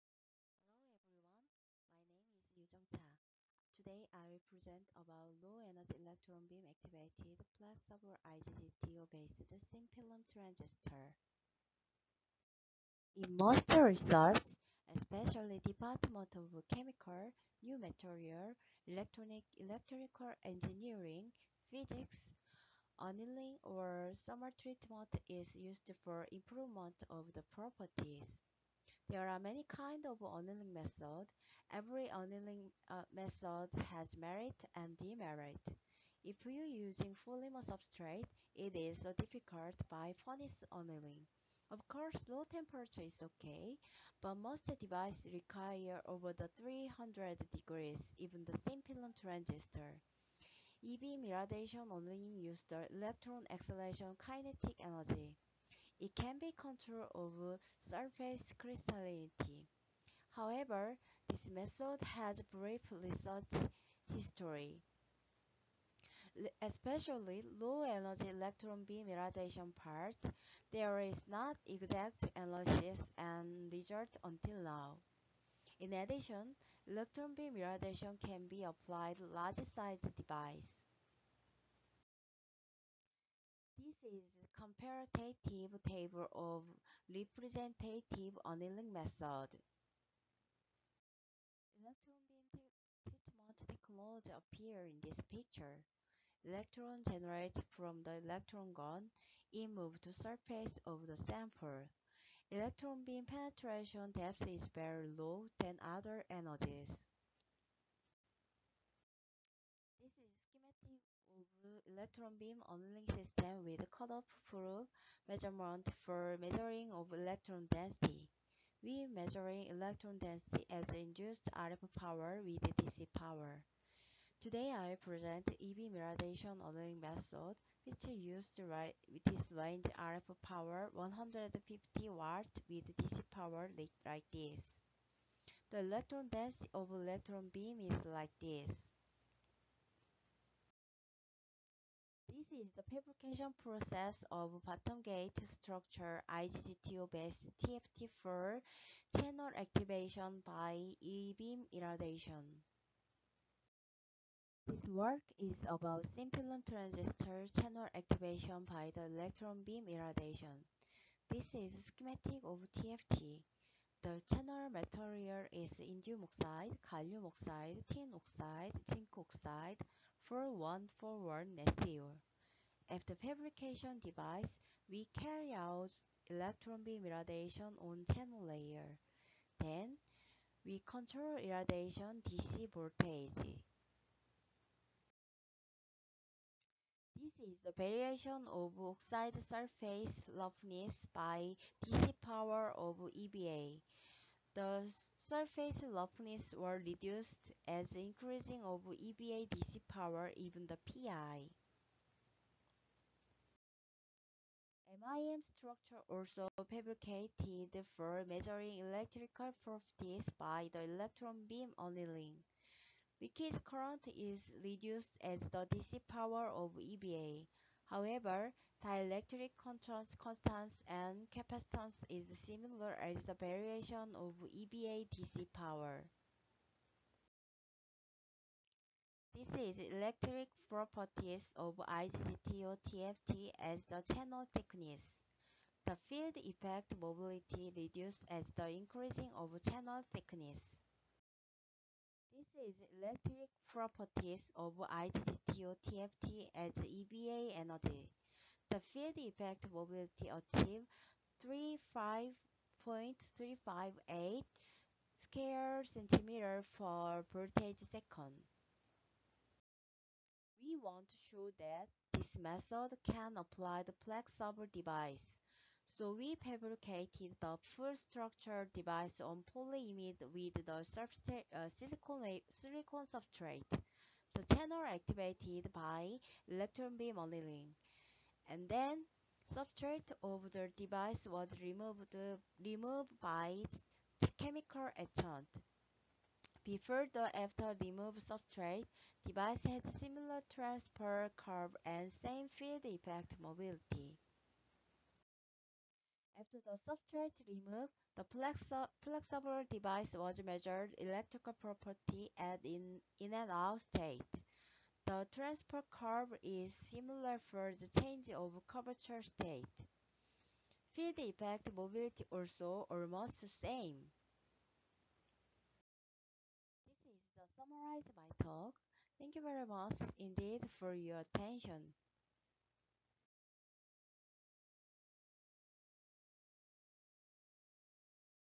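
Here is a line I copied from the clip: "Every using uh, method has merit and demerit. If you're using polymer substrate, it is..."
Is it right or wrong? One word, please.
wrong.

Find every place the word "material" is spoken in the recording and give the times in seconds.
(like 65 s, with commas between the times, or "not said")
17 s, 164 s.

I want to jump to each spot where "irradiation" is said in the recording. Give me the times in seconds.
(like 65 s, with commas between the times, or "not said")
51 s, 69 s, 77 s, 151 s, 159 s, 177 s, 181 s.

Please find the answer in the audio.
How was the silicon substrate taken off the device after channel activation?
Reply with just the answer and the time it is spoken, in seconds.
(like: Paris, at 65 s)
By chemical etchant, at 284 s.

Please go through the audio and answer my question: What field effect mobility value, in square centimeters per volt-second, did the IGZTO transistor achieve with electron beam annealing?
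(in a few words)
35.358.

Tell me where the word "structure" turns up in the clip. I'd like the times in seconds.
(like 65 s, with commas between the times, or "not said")
145 s, 205 s, 267 s.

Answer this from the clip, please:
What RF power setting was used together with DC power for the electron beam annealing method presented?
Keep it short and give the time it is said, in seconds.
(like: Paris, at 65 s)
150 watts, at 130 s.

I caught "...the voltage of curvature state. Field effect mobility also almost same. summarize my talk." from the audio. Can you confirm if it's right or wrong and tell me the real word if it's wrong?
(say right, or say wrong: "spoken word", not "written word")
wrong: "change", not "voltage".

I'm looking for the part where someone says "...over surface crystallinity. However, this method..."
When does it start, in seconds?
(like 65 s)
57 s.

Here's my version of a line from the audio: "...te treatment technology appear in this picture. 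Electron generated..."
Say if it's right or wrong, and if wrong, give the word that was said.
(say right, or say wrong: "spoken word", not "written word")
right.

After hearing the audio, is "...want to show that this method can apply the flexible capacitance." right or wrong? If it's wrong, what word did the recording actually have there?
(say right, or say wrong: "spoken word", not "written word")
wrong: "device", not "capacitance".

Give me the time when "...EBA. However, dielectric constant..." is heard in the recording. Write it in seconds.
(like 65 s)
216 s.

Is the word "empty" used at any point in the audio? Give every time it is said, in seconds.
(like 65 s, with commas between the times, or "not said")
not said.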